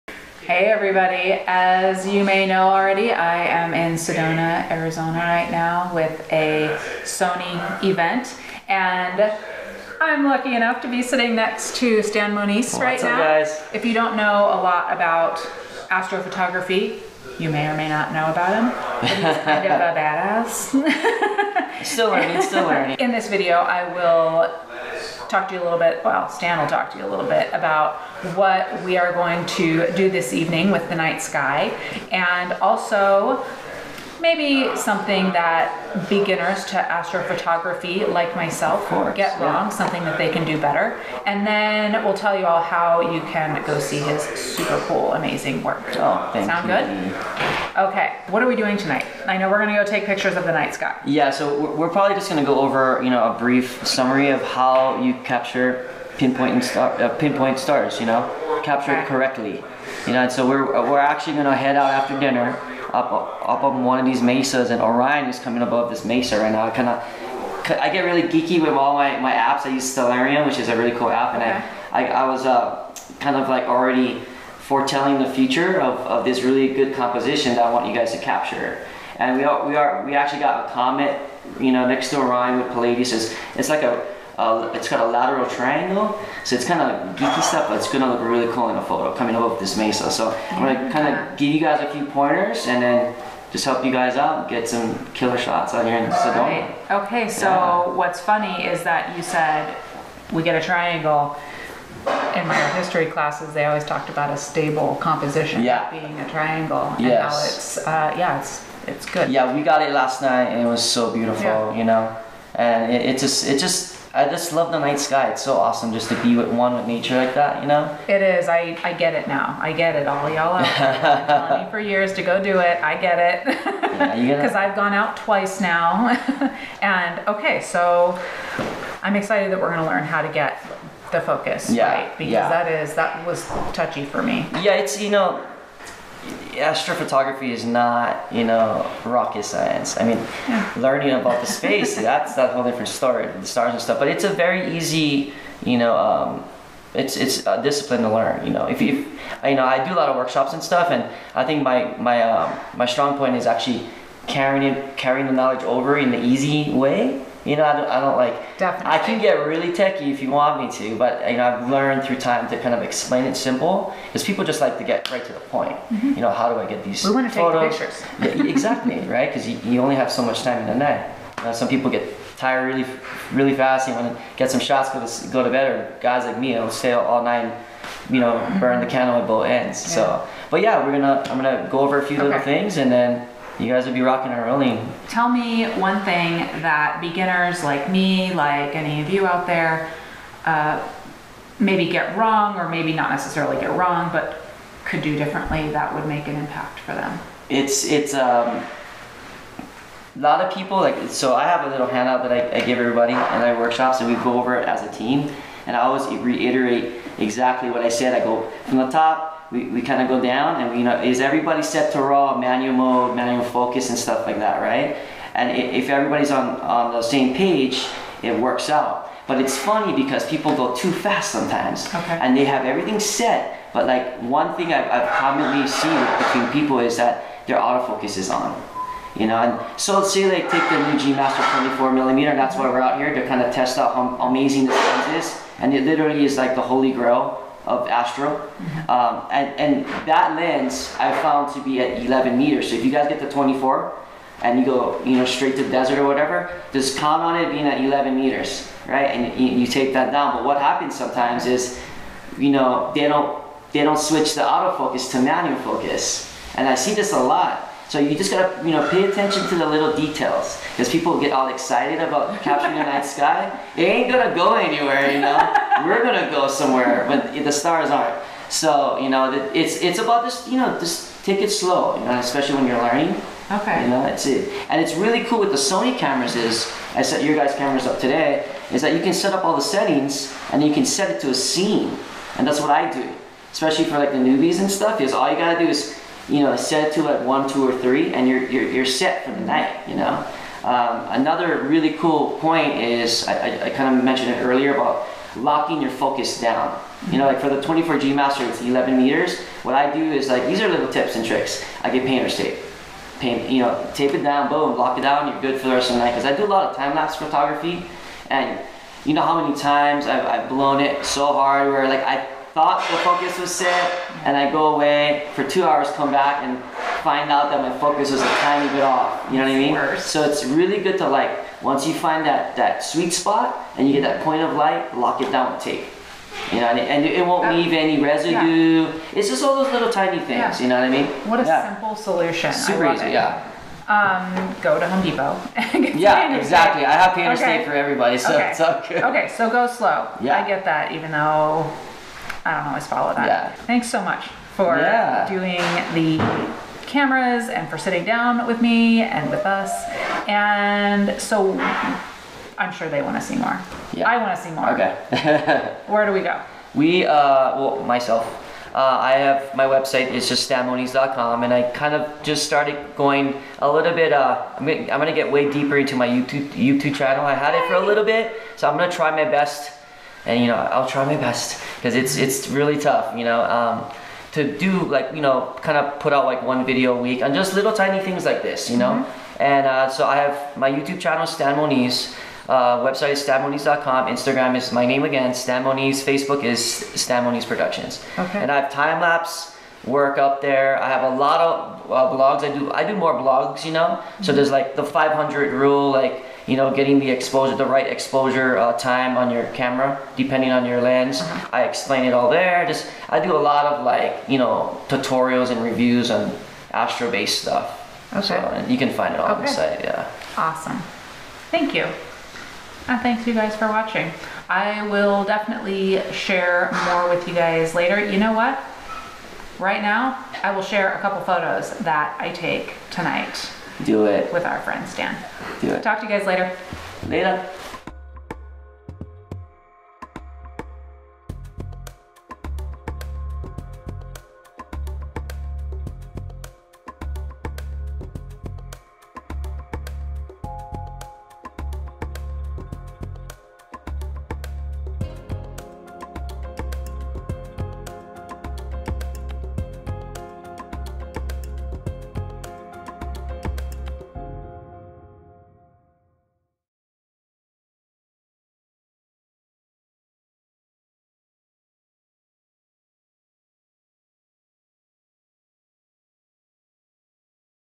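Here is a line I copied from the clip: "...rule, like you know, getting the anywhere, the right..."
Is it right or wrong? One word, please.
wrong.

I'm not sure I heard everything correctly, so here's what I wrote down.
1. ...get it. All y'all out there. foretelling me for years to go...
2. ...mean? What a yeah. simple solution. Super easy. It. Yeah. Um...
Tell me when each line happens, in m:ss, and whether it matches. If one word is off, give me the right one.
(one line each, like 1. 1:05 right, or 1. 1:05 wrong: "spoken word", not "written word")
1. 1:59 wrong: "telling", not "foretelling"
2. 5:30 right.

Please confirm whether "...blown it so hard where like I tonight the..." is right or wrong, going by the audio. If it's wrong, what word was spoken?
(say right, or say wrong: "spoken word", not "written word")
wrong: "thought", not "tonight".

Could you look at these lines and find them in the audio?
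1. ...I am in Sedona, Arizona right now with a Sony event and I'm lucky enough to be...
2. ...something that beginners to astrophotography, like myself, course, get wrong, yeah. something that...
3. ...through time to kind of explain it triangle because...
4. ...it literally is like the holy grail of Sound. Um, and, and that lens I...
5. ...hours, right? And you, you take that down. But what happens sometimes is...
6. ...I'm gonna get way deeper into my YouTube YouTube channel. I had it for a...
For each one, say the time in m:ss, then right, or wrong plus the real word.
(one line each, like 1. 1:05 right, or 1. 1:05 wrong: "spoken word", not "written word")
1. 0:03 right
2. 0:34 right
3. 2:42 wrong: "simple", not "triangle"
4. 3:55 wrong: "Astro", not "Sound"
5. 4:08 wrong: "meters", not "hours"
6. 6:04 right.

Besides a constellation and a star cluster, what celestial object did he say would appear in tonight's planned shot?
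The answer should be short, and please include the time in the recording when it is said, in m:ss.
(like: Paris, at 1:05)
A comet, at 1:20.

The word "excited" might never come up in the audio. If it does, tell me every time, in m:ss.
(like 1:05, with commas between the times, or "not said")
2:09, 4:21.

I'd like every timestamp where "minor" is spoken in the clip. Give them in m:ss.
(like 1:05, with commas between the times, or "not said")
not said.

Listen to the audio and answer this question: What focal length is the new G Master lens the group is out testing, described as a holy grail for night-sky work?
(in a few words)
24 millimeter.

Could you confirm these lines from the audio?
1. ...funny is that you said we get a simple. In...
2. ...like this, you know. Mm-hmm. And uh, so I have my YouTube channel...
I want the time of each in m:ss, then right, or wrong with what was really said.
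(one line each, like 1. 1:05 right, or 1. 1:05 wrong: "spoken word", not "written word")
1. 1:38 wrong: "triangle", not "simple"
2. 6:18 right.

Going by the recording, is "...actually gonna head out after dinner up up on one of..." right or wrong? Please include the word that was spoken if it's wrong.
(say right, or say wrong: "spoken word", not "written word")
right.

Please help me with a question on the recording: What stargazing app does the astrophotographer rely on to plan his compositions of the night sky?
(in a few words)
Stellarium.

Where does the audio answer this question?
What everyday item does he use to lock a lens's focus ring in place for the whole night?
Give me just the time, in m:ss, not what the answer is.
5:02.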